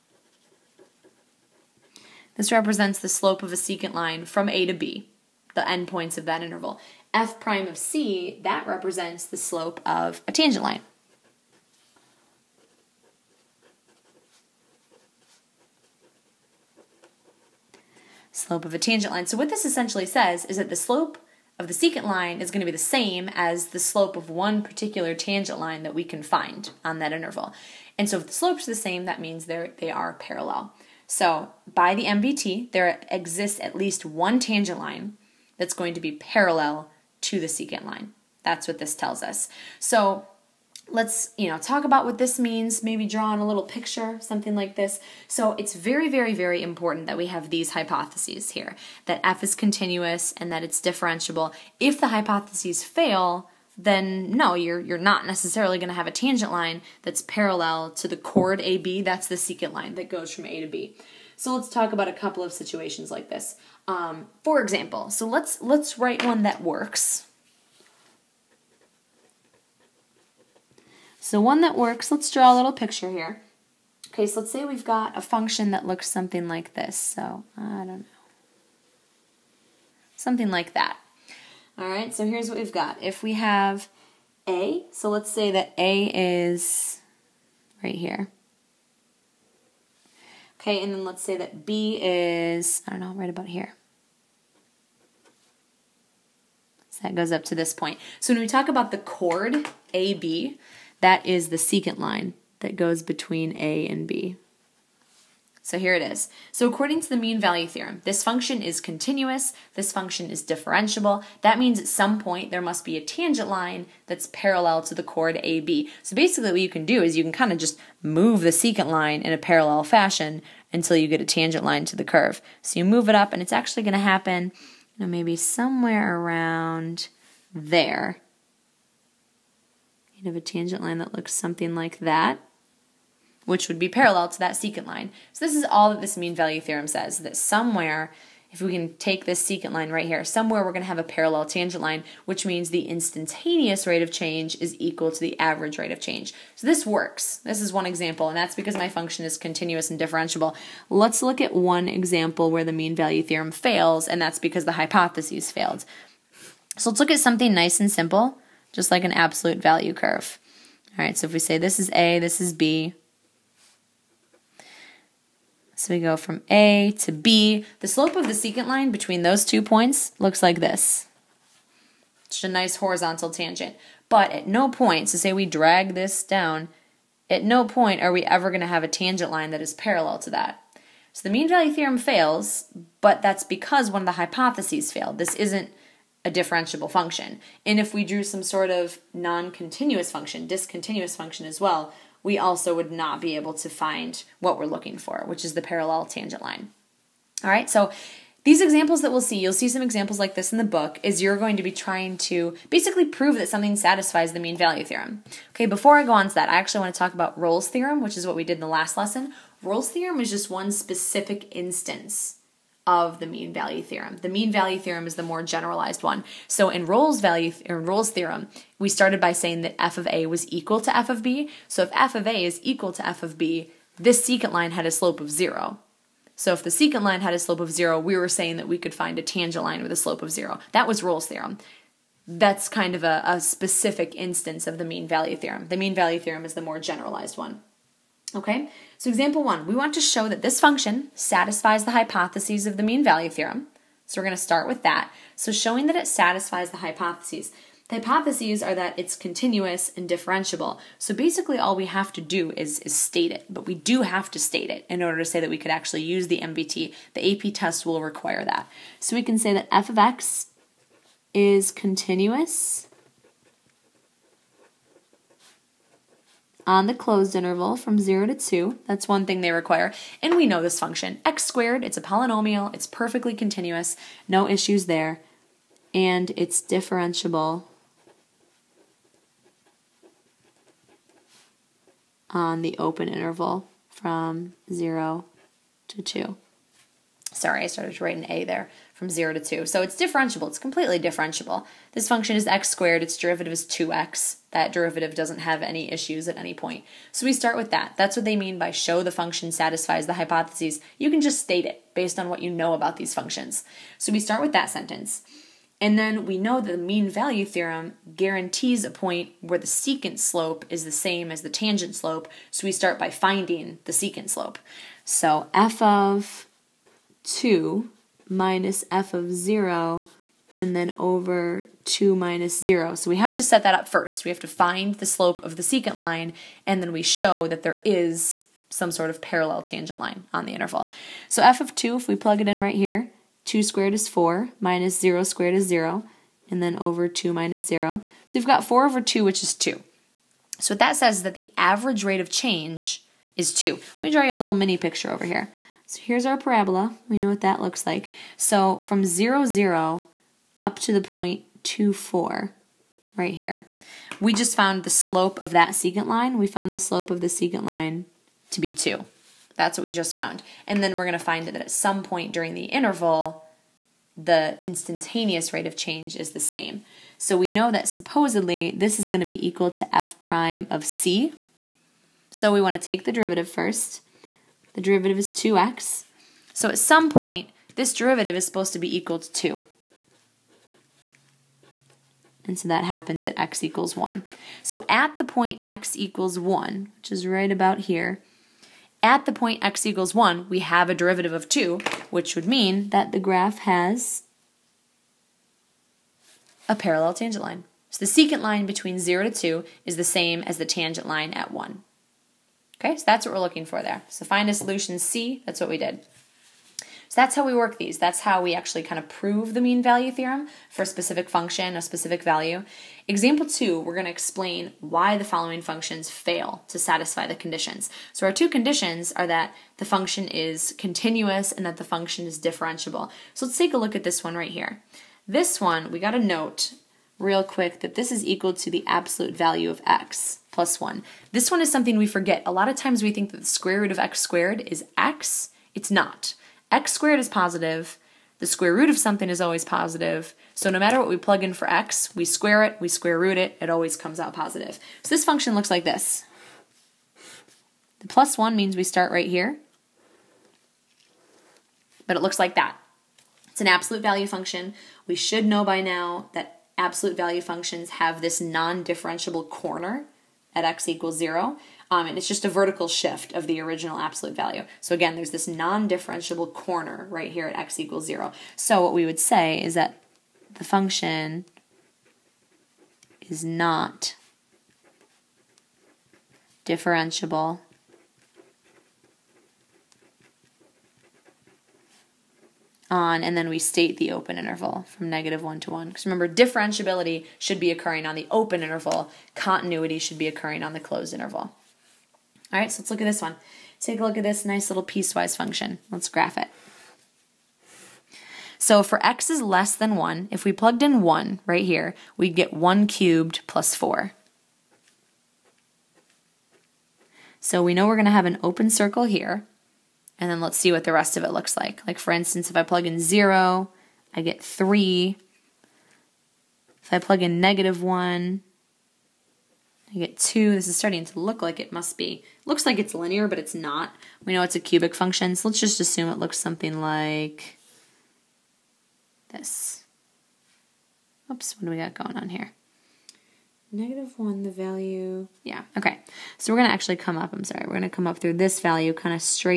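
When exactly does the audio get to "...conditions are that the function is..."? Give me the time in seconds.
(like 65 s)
418 s.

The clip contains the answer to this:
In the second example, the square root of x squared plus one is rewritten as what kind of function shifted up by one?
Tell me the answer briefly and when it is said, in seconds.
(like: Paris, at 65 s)
absolute value of x, at 428 s.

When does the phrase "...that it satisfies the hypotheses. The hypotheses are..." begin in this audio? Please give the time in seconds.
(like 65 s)
245 s.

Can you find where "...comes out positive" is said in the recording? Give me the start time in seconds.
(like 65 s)
443 s.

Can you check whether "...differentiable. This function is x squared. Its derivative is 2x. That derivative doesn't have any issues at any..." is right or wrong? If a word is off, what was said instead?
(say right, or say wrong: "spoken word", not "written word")
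right.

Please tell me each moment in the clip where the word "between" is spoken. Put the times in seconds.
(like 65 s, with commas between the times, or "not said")
103 s, 168 s, 398 s.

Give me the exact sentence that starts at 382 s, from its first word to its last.
And so that happens at x equals 1.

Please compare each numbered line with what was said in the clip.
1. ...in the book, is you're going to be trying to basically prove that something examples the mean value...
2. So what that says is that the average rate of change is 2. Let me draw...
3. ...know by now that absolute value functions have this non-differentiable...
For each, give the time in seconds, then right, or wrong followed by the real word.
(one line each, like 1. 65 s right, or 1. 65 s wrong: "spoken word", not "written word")
1. 200 s wrong: "satisfies", not "examples"
2. 340 s right
3. 455 s right.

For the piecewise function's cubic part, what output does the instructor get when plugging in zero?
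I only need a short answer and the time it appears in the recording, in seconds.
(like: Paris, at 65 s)
3, at 514 s.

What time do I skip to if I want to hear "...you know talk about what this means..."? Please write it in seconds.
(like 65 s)
41 s.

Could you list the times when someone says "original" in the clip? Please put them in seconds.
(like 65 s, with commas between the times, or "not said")
463 s.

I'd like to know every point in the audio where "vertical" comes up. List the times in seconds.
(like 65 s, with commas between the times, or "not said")
462 s.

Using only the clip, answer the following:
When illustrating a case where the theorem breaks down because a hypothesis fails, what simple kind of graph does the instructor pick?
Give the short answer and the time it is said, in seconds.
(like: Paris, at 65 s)
Absolute value curve, at 159 s.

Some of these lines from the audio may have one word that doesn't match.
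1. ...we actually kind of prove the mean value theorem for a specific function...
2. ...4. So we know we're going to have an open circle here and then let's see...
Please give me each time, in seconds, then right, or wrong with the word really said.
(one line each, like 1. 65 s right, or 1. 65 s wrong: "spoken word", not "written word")
1. 408 s right
2. 503 s right.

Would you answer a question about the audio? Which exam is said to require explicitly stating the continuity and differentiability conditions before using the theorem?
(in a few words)
AP test.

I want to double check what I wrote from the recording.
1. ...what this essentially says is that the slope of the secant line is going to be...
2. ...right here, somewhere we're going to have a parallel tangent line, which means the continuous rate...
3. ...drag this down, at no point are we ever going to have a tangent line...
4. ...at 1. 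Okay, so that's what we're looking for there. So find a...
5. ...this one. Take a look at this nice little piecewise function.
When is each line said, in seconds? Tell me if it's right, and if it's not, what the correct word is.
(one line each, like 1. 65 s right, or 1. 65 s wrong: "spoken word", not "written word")
1. 19 s right
2. 139 s wrong: "instantaneous", not "continuous"
3. 175 s right
4. 401 s right
5. 493 s right.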